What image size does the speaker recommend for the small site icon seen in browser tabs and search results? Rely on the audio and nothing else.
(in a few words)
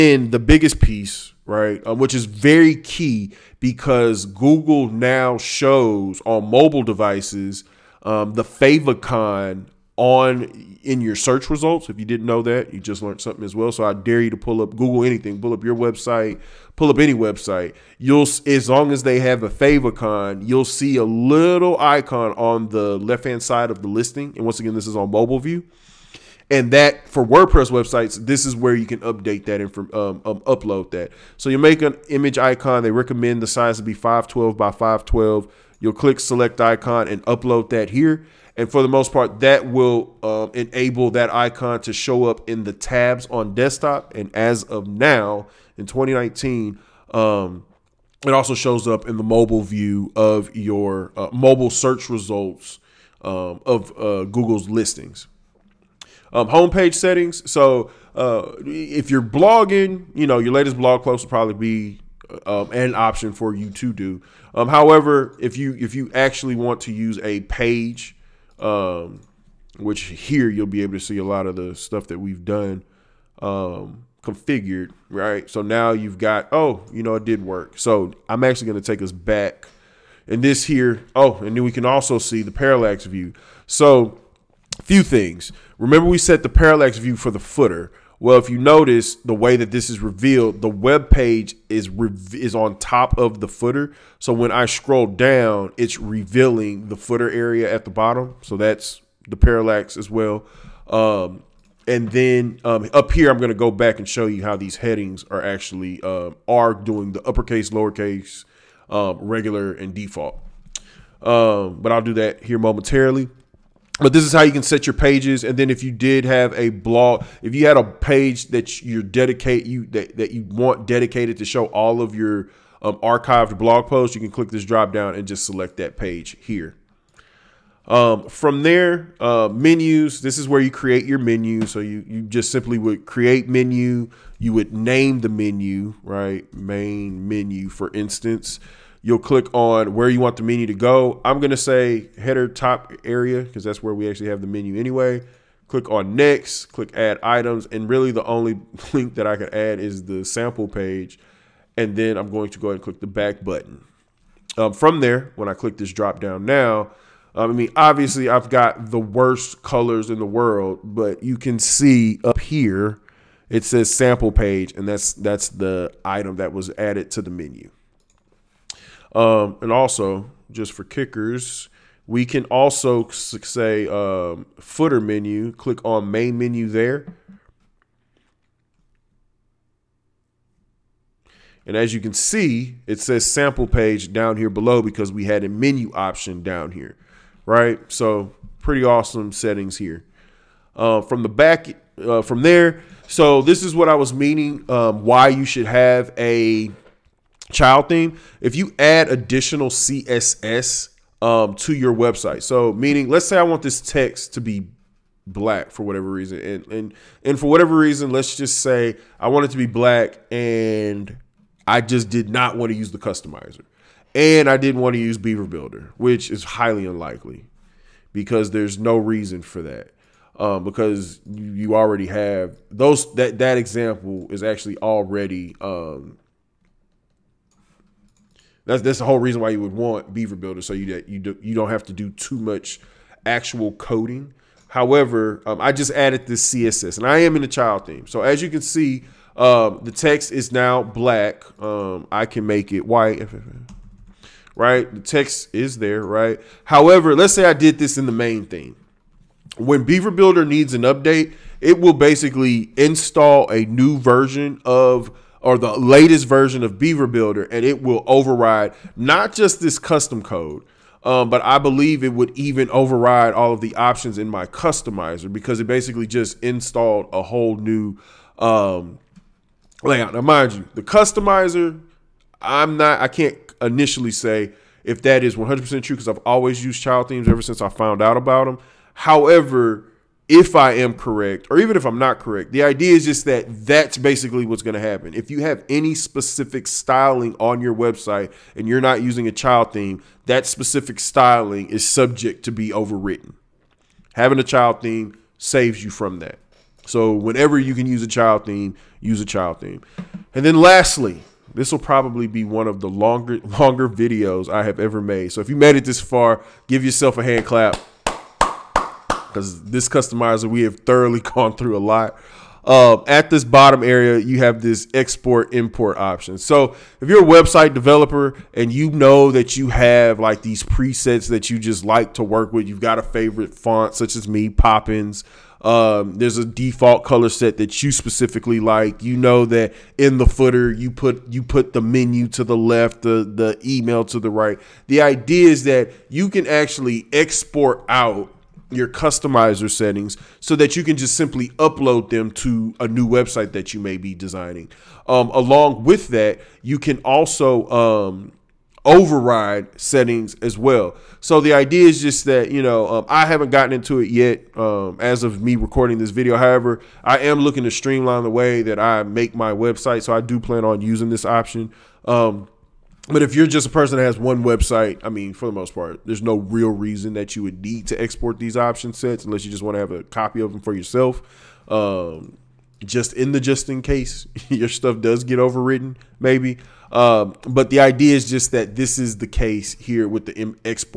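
512 by 512.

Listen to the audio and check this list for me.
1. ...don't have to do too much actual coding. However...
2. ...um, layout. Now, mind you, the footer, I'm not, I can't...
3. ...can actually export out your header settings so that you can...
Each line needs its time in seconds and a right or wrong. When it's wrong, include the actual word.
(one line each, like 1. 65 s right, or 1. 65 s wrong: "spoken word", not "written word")
1. 231 s right
2. 268 s wrong: "customizer", not "footer"
3. 336 s wrong: "customizer", not "header".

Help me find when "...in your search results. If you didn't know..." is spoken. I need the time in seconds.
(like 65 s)
10 s.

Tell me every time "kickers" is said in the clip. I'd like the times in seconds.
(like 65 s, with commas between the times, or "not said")
170 s.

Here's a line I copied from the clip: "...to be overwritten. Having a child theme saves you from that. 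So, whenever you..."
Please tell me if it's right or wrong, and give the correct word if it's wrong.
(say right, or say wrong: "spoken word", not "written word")
right.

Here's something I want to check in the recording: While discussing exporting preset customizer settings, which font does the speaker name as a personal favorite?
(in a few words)
Poppins.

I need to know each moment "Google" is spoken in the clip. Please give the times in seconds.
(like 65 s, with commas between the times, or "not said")
4 s, 14 s, 54 s.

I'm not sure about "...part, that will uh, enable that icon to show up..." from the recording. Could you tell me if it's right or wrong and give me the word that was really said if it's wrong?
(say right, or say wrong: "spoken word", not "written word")
right.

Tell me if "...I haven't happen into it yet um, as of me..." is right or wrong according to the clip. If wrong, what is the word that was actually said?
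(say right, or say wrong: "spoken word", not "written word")
wrong: "gotten", not "happen".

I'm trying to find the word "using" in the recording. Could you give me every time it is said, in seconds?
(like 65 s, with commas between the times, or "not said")
289 s, 360 s.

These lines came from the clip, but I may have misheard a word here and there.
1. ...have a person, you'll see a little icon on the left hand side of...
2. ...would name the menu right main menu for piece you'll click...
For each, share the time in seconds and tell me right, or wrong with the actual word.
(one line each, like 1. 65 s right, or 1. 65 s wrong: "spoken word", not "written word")
1. 19 s wrong: "favicon", not "person"
2. 134 s wrong: "instance", not "piece".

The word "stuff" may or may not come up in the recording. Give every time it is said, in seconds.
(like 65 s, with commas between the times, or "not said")
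71 s, 374 s.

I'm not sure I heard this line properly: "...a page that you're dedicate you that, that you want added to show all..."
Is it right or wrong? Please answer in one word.
wrong.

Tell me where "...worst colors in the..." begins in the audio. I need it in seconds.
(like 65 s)
158 s.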